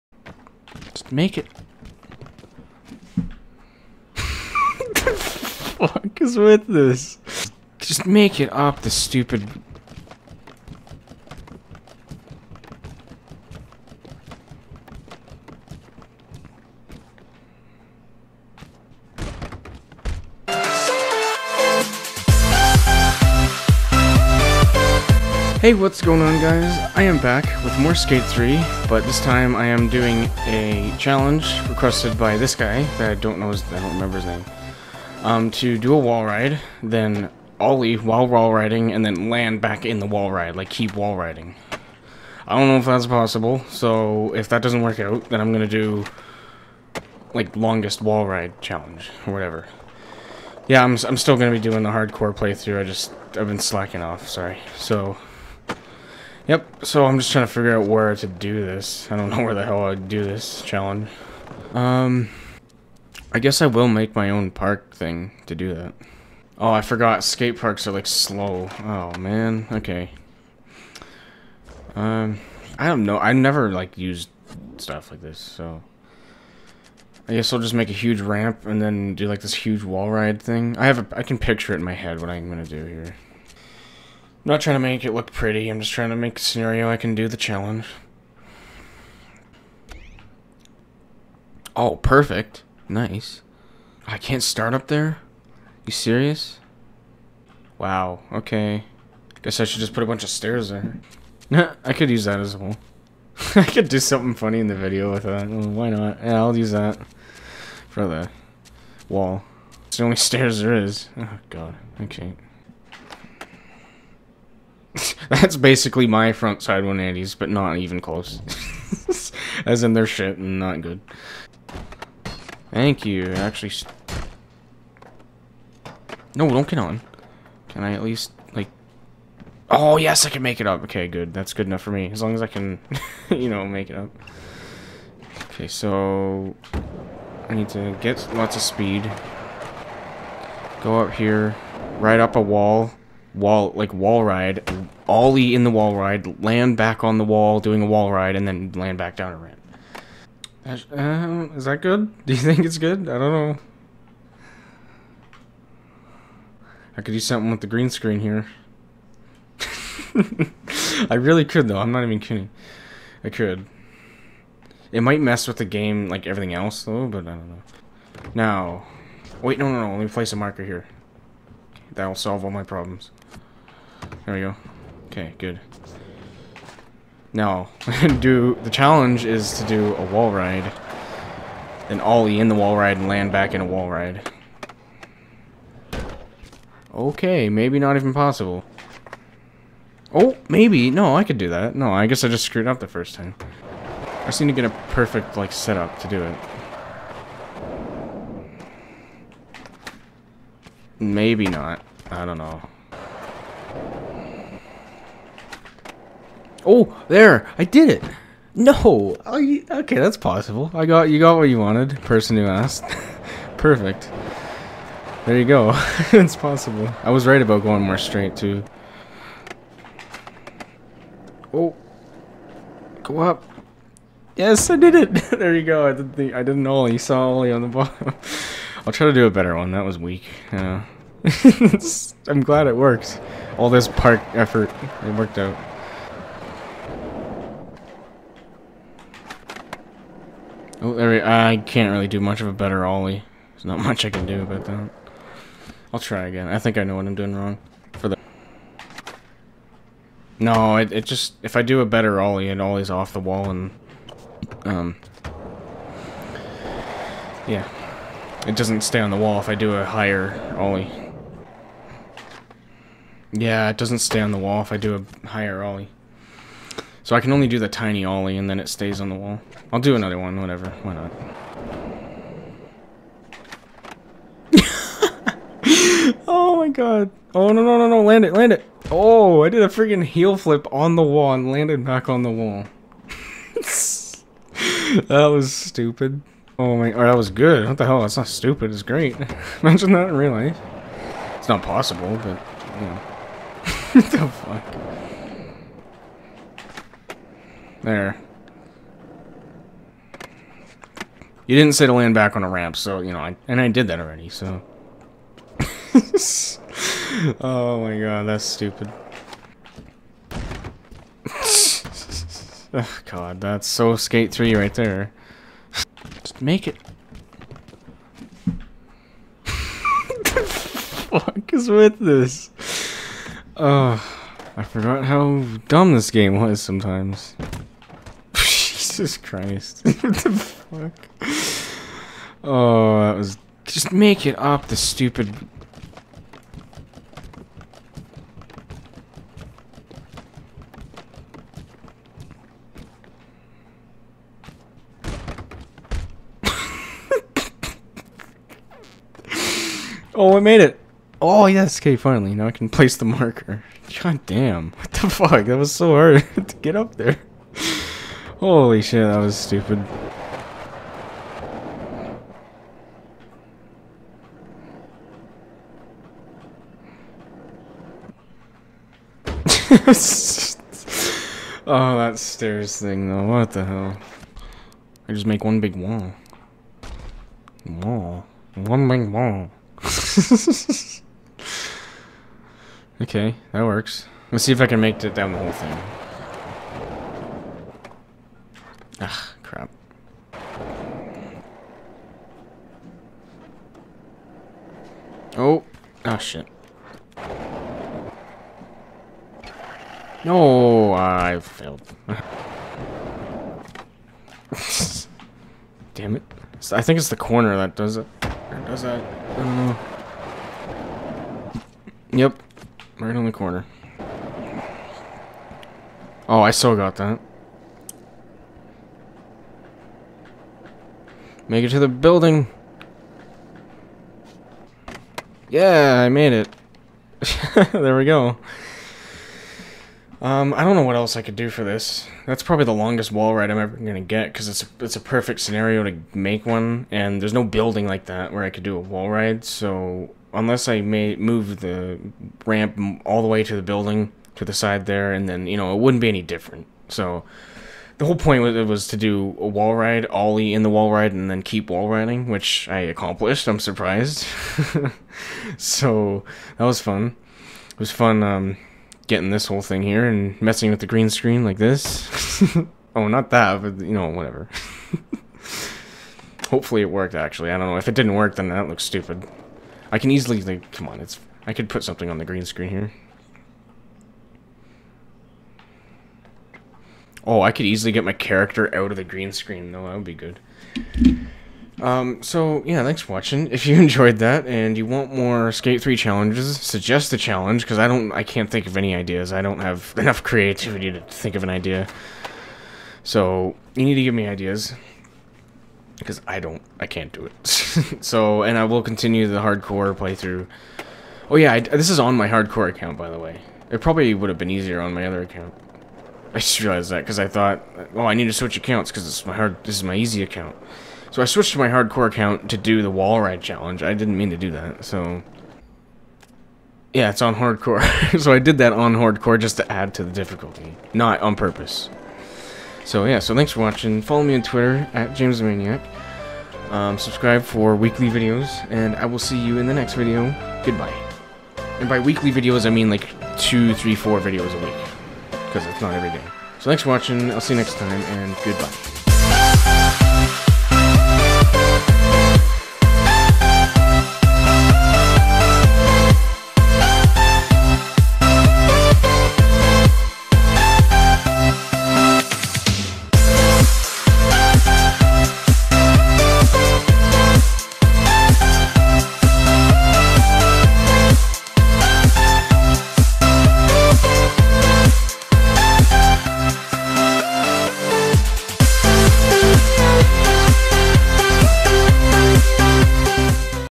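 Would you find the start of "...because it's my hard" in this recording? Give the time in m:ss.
8:28.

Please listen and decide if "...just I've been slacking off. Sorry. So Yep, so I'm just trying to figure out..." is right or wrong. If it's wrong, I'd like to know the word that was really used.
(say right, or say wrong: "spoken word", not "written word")
right.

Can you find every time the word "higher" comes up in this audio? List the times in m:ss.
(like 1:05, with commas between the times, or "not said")
4:19, 4:25.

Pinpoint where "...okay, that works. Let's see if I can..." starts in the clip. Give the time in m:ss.
6:23.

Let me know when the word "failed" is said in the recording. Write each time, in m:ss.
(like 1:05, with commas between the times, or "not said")
6:41.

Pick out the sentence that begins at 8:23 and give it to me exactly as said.
It probably would have been easier on my other account.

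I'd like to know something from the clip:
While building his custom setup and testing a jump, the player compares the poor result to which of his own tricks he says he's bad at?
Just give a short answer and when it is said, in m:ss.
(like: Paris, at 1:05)
front side 180s, at 1:56.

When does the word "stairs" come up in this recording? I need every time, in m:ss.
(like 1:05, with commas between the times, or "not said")
1:40, 1:50, 6:12.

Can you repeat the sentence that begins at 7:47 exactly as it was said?
If it didn't work, then that looks stupid.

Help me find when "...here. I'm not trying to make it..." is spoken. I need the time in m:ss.
1:22.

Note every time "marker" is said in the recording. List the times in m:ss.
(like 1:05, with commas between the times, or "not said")
2:50, 5:53.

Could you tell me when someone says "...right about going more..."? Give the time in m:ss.
3:37.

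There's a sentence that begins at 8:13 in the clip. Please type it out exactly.
So, you need to give me ideas, because I don't, I can't do it.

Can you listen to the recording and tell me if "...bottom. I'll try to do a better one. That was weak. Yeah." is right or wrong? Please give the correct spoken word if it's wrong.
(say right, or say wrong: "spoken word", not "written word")
right.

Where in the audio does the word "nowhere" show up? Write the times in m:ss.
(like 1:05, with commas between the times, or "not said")
not said.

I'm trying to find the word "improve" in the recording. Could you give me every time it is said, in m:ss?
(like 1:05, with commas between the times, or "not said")
not said.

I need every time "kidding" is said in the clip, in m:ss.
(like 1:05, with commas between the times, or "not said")
2:42.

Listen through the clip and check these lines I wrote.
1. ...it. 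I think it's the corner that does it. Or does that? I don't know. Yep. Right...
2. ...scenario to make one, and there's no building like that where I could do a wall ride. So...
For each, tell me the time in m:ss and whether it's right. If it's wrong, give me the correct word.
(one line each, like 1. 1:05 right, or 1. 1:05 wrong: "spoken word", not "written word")
1. 6:46 right
2. 7:15 right.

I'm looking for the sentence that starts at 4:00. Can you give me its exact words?
Oh, I can't really do much of a better ollie.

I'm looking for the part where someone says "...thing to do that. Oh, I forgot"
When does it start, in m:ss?
1:04.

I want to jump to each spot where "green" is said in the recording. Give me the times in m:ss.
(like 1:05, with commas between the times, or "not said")
2:37, 7:40, 7:52, 7:59.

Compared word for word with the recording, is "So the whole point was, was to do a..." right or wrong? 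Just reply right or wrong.
right.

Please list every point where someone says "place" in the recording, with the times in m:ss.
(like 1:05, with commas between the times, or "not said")
2:50, 5:52.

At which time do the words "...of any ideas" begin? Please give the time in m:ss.
8:08.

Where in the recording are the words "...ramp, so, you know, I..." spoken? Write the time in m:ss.
5:02.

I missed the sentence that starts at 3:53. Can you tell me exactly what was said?
All this park effort, it worked out.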